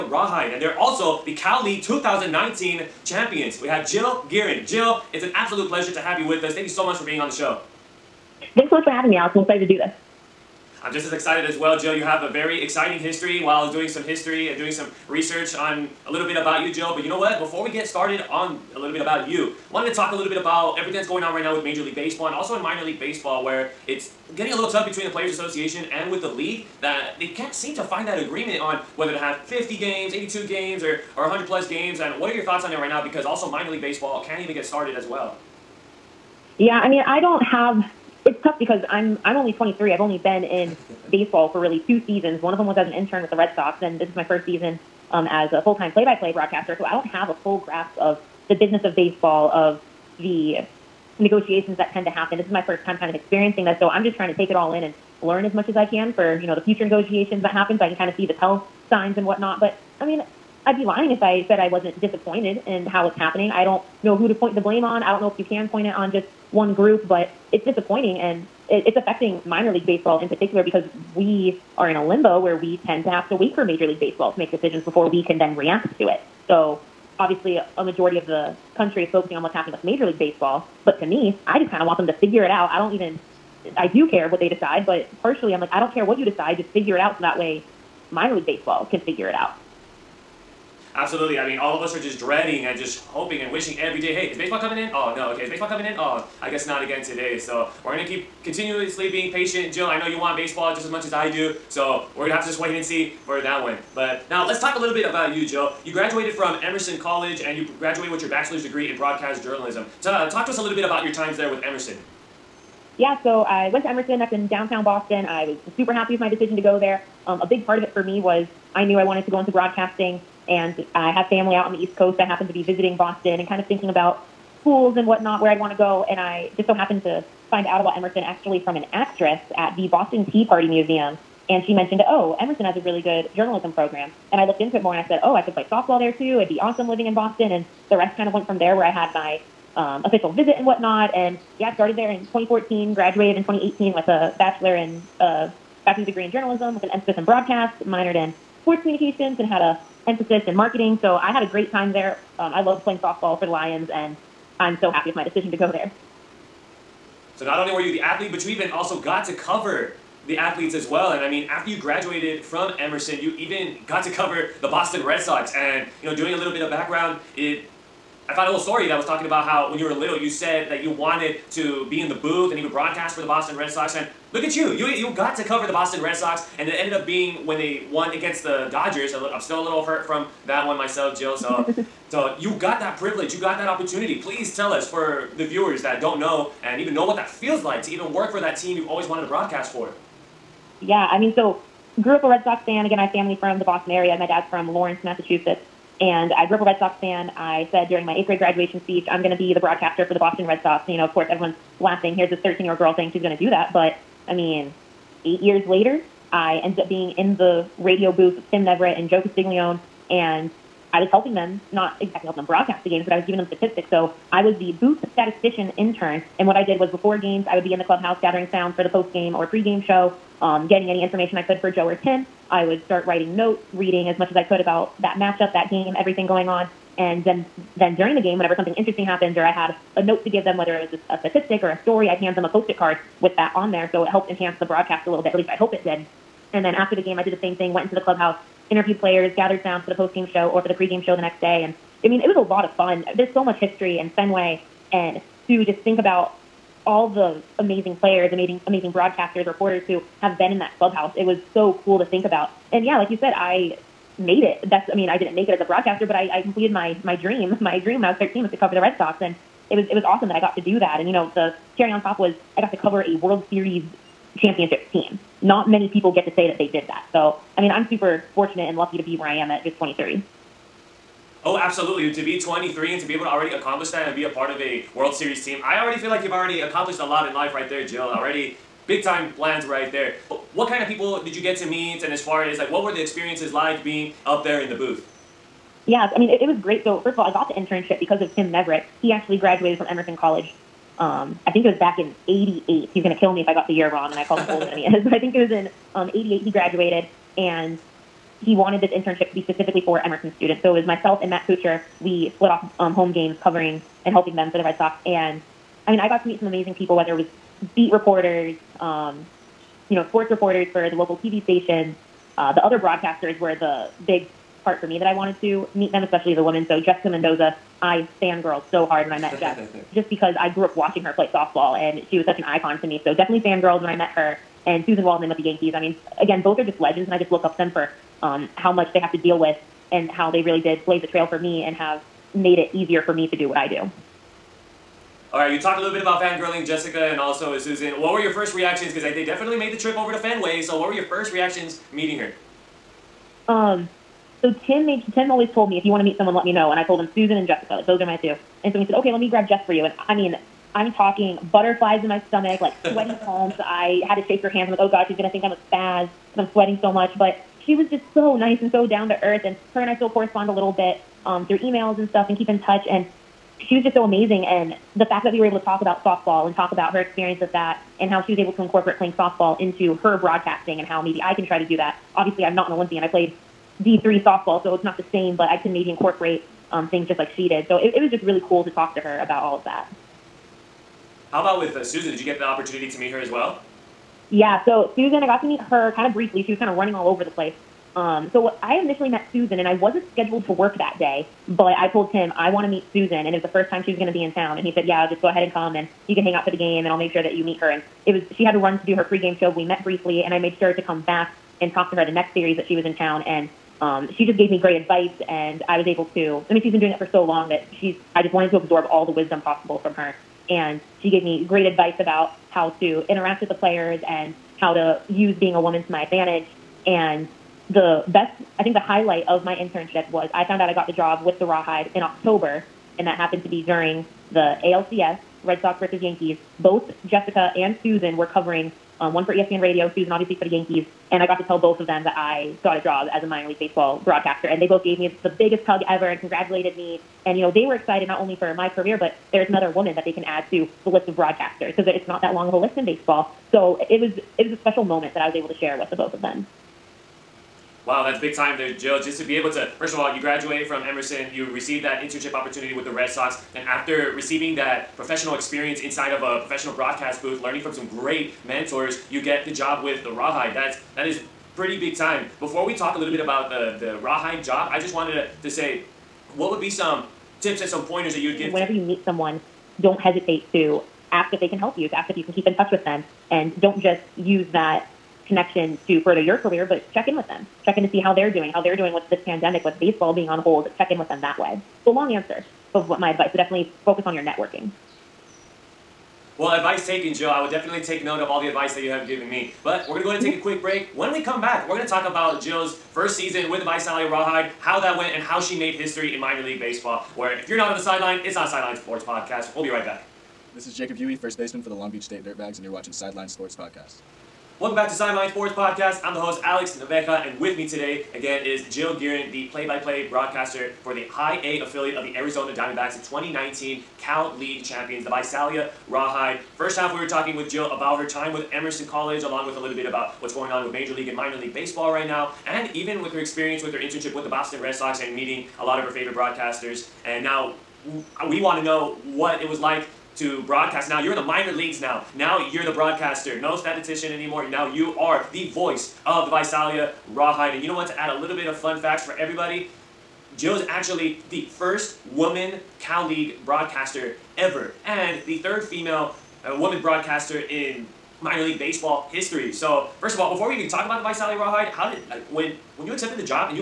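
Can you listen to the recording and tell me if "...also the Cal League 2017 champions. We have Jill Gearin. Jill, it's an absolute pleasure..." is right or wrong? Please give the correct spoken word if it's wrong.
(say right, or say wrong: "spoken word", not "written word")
wrong: "2019", not "2017".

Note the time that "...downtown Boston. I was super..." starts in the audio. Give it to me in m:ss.
1:54.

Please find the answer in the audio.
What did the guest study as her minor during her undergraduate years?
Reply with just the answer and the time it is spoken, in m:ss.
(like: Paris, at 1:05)
sports communications, at 2:28.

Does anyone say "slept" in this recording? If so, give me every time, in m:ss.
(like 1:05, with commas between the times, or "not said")
not said.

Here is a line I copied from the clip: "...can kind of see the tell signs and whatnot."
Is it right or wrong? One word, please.
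right.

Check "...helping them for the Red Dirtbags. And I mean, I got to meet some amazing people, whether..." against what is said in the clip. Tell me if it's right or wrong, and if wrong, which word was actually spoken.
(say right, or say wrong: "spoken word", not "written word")
wrong: "Sox", not "Dirtbags".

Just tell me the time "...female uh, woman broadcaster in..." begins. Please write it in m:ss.
9:05.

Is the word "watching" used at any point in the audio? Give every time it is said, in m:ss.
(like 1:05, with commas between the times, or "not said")
5:20, 8:22.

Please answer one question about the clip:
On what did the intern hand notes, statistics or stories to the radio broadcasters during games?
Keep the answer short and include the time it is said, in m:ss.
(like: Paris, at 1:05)
post-it card, at 3:52.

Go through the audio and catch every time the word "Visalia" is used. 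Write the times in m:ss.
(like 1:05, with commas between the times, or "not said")
8:13, 8:35, 8:56, 9:11.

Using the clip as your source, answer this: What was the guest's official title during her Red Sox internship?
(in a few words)
booth statistician intern.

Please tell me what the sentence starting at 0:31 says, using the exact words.
And what are your thoughts on that right now?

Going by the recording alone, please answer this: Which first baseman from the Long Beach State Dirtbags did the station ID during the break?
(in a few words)
Jacob Huey.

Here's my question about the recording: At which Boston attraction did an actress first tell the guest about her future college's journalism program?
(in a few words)
Boston Tea Party Museum.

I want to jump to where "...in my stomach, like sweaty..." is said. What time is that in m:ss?
5:52.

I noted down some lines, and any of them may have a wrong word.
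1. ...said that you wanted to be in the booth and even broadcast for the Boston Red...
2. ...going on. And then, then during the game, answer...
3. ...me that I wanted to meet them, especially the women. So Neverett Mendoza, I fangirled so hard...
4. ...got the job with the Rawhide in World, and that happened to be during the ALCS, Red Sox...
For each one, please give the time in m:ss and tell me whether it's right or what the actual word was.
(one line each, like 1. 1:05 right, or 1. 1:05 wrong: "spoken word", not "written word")
1. 2:50 right
2. 3:46 wrong: "whenever", not "answer"
3. 5:14 wrong: "Jessica", not "Neverett"
4. 7:00 wrong: "October", not "World".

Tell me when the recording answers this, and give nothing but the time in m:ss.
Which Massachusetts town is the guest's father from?
3:14.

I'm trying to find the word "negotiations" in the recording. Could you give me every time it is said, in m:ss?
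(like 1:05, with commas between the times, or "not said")
0:51, 0:56.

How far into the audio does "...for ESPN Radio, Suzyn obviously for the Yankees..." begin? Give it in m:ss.
7:09.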